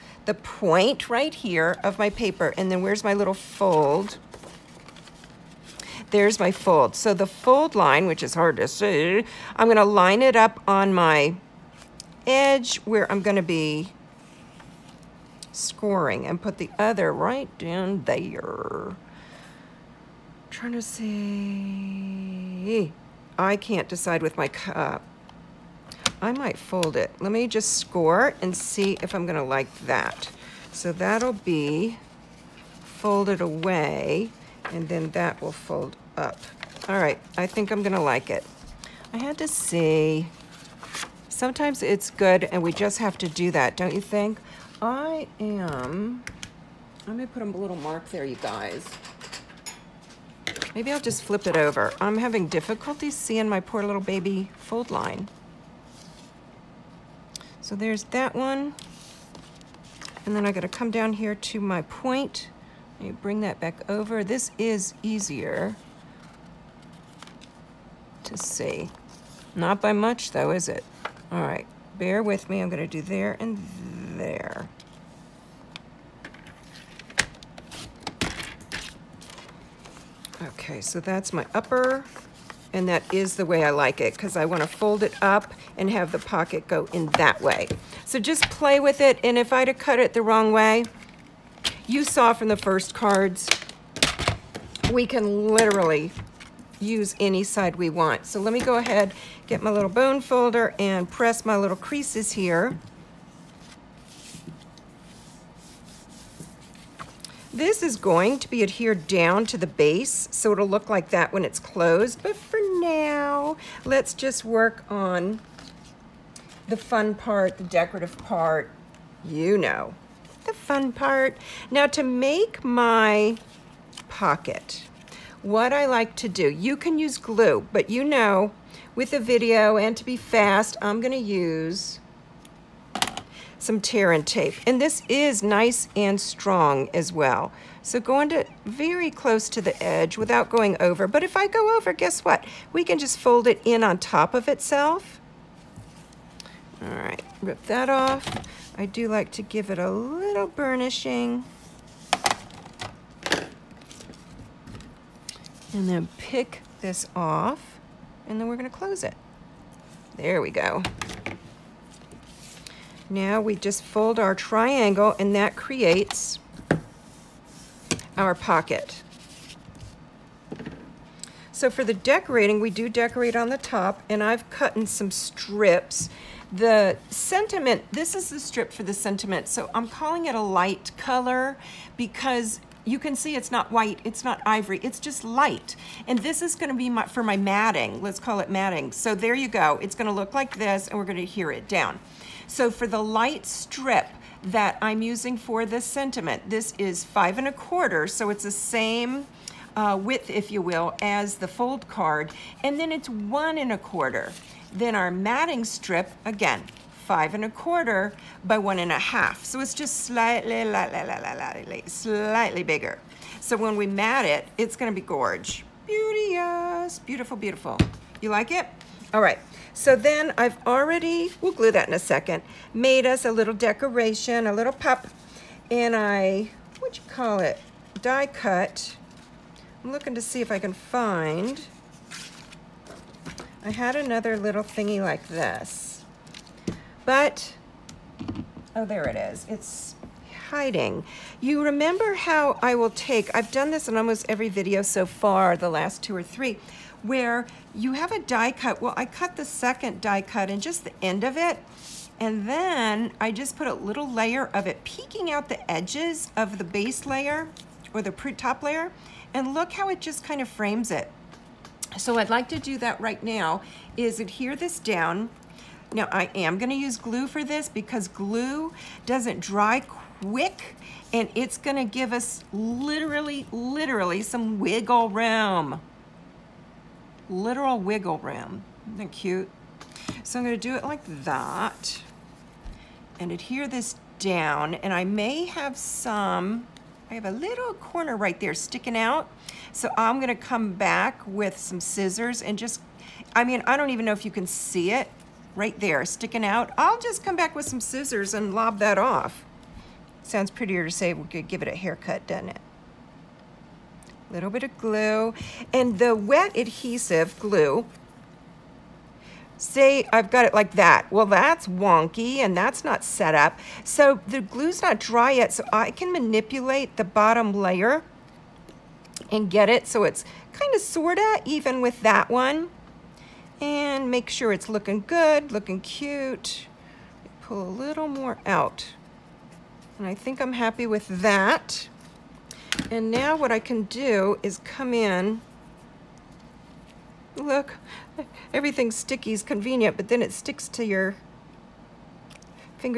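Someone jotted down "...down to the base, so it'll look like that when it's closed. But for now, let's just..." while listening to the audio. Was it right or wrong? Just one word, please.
right.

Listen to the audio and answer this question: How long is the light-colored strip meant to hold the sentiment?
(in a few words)
1 1/4.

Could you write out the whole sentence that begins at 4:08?
Well, I cut the second die cut and just the end of it.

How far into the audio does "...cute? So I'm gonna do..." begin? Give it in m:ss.
4:39.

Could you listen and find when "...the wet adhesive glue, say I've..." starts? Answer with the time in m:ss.
5:05.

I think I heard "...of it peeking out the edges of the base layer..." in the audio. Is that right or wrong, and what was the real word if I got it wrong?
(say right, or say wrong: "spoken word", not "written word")
right.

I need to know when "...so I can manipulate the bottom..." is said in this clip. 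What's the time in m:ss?
5:15.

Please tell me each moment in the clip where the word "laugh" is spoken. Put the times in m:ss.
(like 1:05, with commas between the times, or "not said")
not said.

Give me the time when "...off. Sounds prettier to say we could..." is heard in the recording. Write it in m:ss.
4:58.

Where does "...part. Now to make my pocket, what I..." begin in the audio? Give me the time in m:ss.
2:00.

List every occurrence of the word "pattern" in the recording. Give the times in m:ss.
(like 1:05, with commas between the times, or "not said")
not said.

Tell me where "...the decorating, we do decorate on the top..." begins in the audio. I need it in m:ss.
2:51.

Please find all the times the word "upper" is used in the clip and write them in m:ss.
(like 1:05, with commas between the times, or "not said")
1:21.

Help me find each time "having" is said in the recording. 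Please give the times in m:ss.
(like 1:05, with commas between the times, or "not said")
0:52.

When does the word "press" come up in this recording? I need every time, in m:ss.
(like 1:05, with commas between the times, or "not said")
1:41.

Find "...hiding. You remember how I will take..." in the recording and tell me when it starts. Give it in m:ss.
4:00.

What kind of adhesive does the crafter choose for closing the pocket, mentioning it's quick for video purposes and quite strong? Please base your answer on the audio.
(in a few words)
tear and tape.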